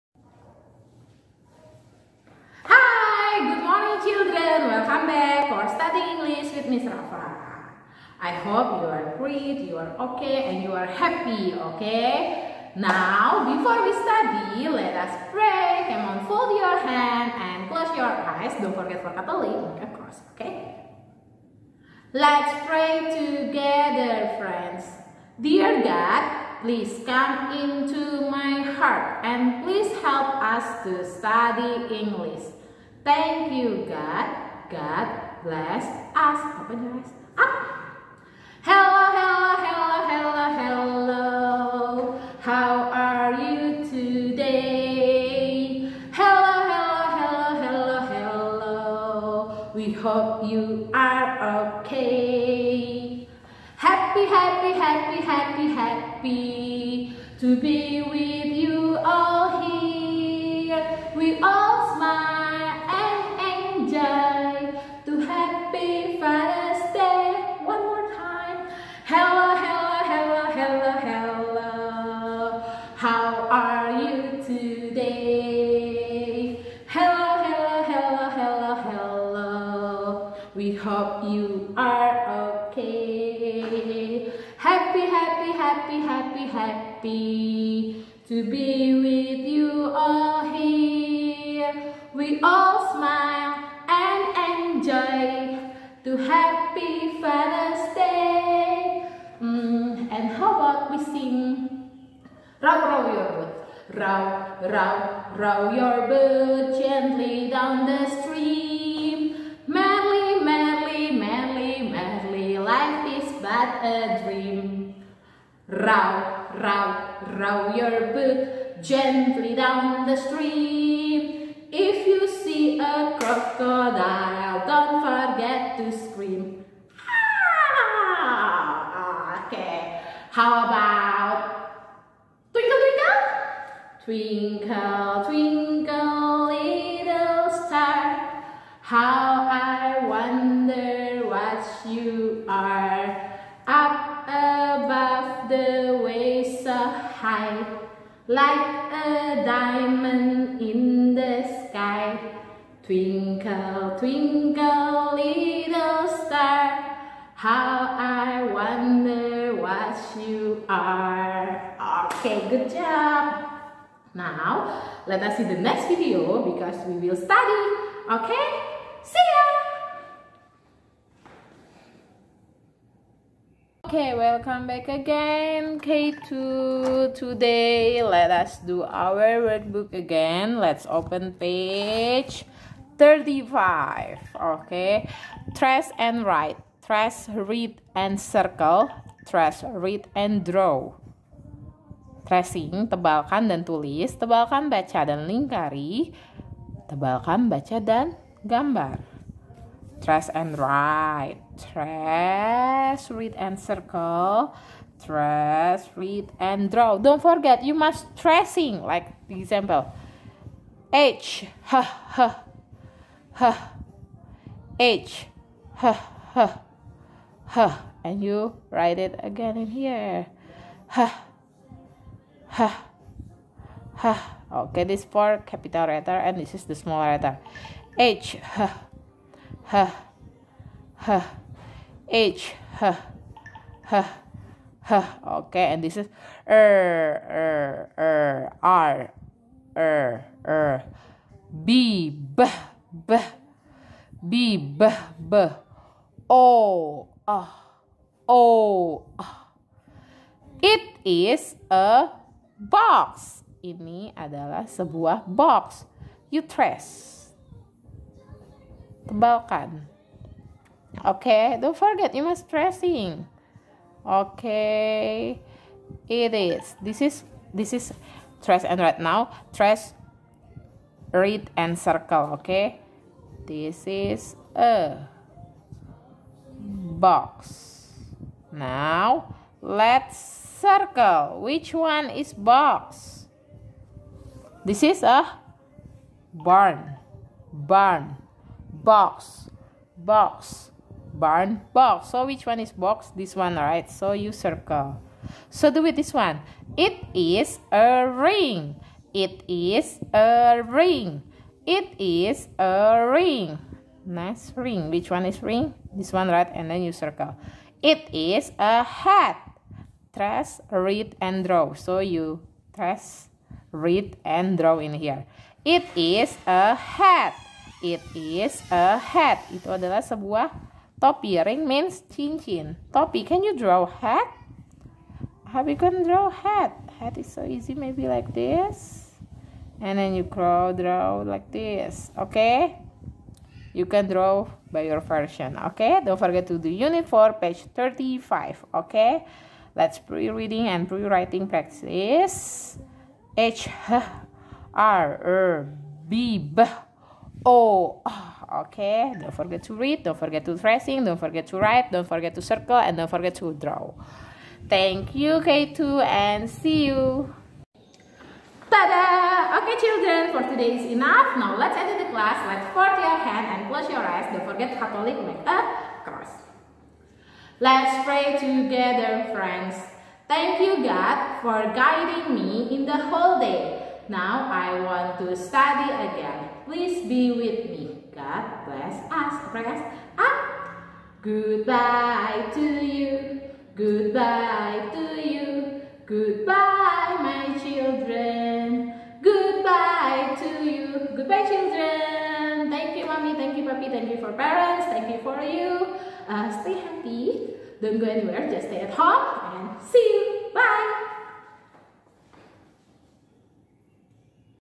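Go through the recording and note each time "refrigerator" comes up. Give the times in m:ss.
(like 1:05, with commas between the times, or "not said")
not said.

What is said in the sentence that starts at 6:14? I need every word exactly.
Now I want to study again.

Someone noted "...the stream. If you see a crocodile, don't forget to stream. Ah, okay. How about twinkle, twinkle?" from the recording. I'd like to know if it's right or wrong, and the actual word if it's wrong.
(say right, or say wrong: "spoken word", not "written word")
wrong: "scream", not "stream".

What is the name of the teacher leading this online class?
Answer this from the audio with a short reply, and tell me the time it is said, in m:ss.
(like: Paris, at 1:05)
Miss Rafa, at 0:06.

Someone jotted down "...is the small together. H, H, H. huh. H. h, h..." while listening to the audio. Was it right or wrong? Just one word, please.
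wrong.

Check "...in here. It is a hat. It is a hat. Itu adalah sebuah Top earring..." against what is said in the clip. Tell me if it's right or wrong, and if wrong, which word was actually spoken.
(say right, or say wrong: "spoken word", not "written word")
right.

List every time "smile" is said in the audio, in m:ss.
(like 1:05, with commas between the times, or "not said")
1:01, 1:32.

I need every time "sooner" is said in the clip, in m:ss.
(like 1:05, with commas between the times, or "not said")
not said.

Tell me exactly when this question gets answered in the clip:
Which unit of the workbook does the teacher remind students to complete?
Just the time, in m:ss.
5:36.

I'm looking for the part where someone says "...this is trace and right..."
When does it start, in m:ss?
4:27.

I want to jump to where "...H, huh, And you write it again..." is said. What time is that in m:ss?
3:35.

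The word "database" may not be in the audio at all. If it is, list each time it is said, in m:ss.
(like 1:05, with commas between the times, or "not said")
not said.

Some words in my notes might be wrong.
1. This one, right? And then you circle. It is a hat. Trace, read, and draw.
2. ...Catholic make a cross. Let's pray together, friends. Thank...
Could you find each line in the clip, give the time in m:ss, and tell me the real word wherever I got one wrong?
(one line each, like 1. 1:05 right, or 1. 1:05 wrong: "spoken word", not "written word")
1. 5:05 right
2. 6:04 right.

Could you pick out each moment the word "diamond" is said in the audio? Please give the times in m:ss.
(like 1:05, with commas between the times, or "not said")
2:29.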